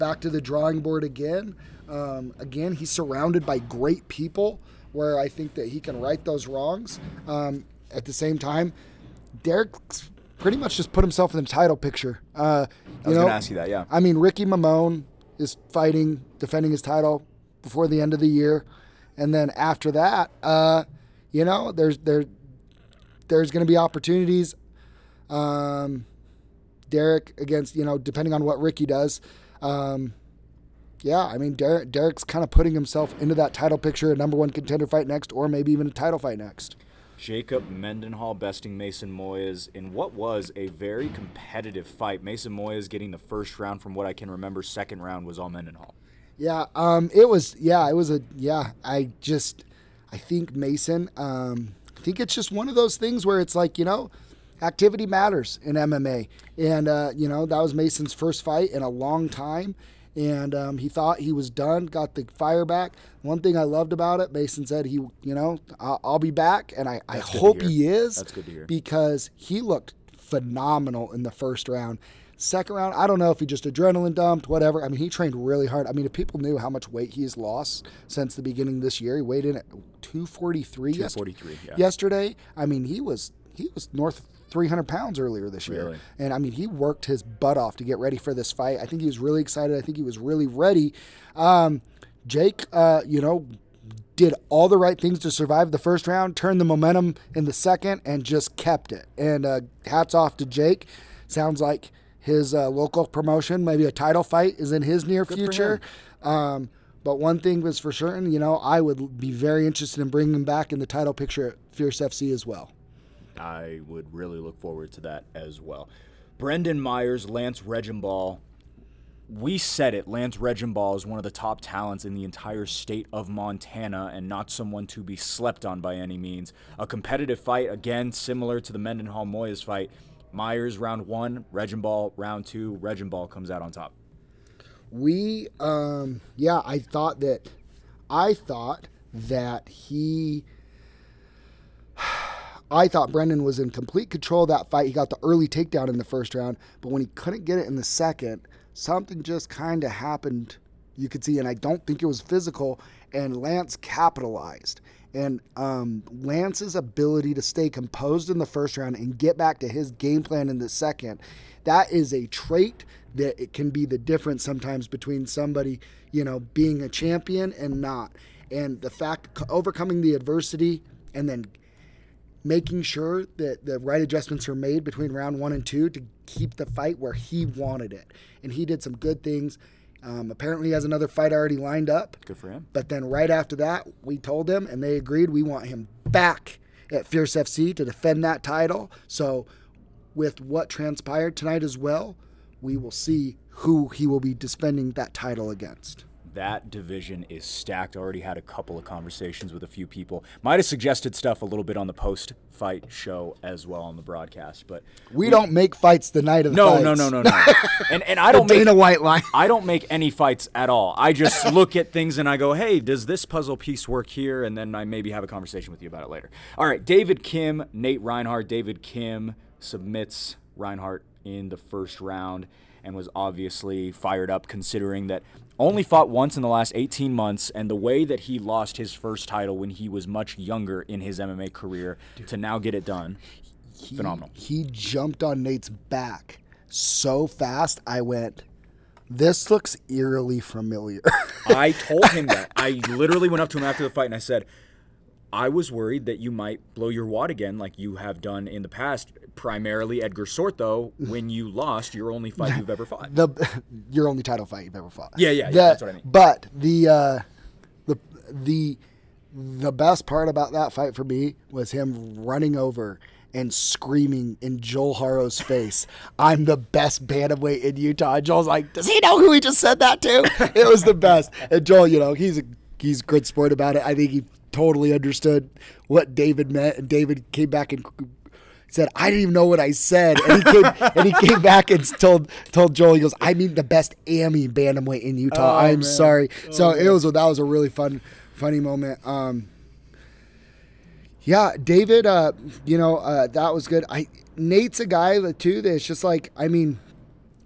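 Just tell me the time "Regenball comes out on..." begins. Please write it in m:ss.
2:12.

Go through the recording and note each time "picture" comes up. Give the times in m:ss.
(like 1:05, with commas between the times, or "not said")
0:11, 0:33, 1:51.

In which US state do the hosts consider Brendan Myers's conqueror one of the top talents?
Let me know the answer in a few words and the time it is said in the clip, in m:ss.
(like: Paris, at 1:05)
Montana, at 2:03.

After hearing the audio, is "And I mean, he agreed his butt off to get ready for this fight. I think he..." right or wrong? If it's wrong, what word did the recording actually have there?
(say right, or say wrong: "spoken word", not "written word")
wrong: "worked", not "agreed".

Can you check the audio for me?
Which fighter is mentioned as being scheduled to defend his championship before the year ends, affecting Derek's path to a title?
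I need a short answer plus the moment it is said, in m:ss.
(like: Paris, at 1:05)
Ricky Mamone, at 0:14.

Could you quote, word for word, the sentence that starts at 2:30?
You could see, and I don't think it was physical.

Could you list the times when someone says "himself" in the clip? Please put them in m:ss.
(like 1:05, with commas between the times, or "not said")
0:11, 0:32.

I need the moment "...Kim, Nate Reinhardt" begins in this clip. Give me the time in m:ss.
3:37.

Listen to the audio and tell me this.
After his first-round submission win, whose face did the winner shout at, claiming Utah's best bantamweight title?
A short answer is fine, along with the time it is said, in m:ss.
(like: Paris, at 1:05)
Joel Harrow, at 4:24.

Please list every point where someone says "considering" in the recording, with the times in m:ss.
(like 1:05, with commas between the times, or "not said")
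3:44.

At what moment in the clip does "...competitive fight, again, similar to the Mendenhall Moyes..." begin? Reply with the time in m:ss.
2:06.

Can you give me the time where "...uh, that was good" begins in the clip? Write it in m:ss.
4:52.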